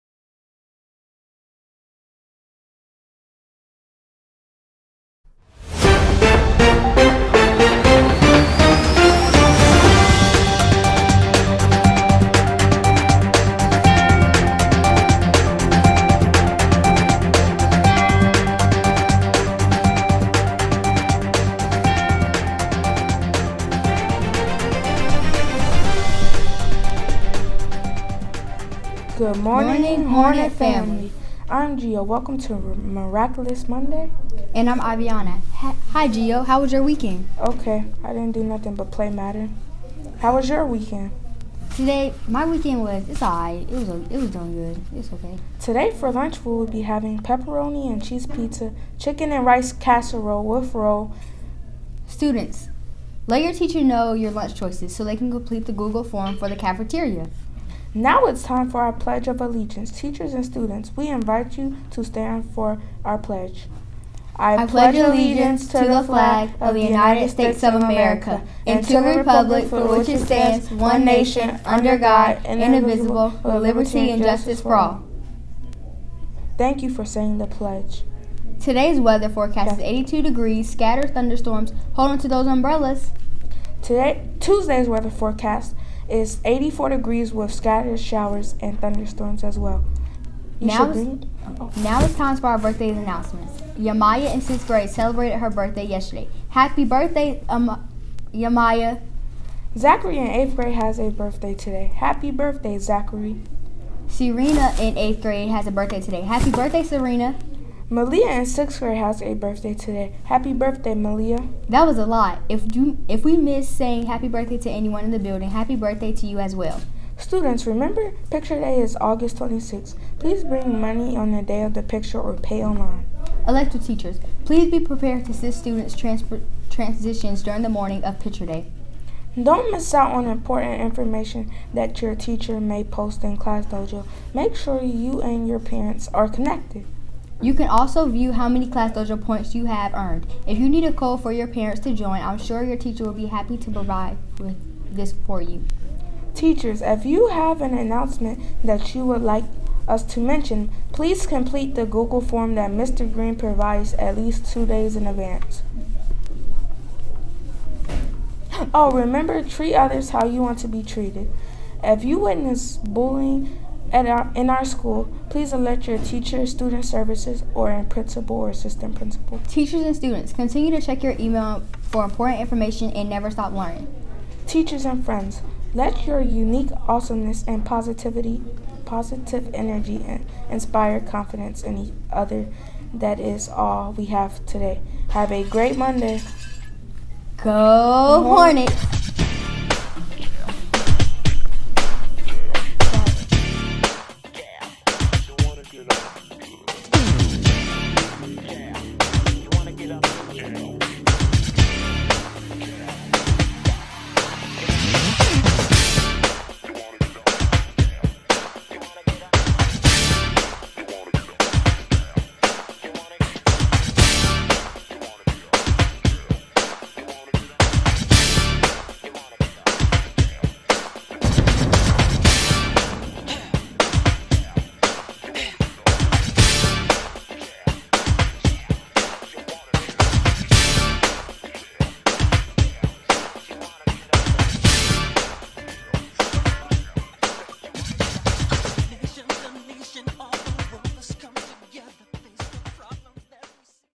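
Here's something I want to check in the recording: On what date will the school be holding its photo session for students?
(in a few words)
August 26th.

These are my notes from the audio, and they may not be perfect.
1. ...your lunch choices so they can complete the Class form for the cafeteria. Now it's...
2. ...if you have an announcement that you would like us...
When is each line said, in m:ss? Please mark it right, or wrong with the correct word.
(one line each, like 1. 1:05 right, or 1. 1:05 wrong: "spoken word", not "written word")
1. 0:54 wrong: "Google", not "Class"
2. 2:26 right.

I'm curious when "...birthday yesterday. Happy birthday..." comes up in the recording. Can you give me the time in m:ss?
1:35.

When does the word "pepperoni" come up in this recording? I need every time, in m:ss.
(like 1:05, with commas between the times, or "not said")
0:47.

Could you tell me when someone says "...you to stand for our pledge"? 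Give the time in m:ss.
1:01.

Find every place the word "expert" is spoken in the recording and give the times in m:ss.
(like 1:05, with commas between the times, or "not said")
not said.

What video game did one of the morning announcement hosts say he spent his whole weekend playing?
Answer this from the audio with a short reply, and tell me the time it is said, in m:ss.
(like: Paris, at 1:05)
Madden, at 0:39.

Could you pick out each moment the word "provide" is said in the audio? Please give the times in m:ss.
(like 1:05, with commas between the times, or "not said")
2:23, 2:33.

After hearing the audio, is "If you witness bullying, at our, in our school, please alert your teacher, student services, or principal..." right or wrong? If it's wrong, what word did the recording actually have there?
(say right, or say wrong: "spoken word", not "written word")
right.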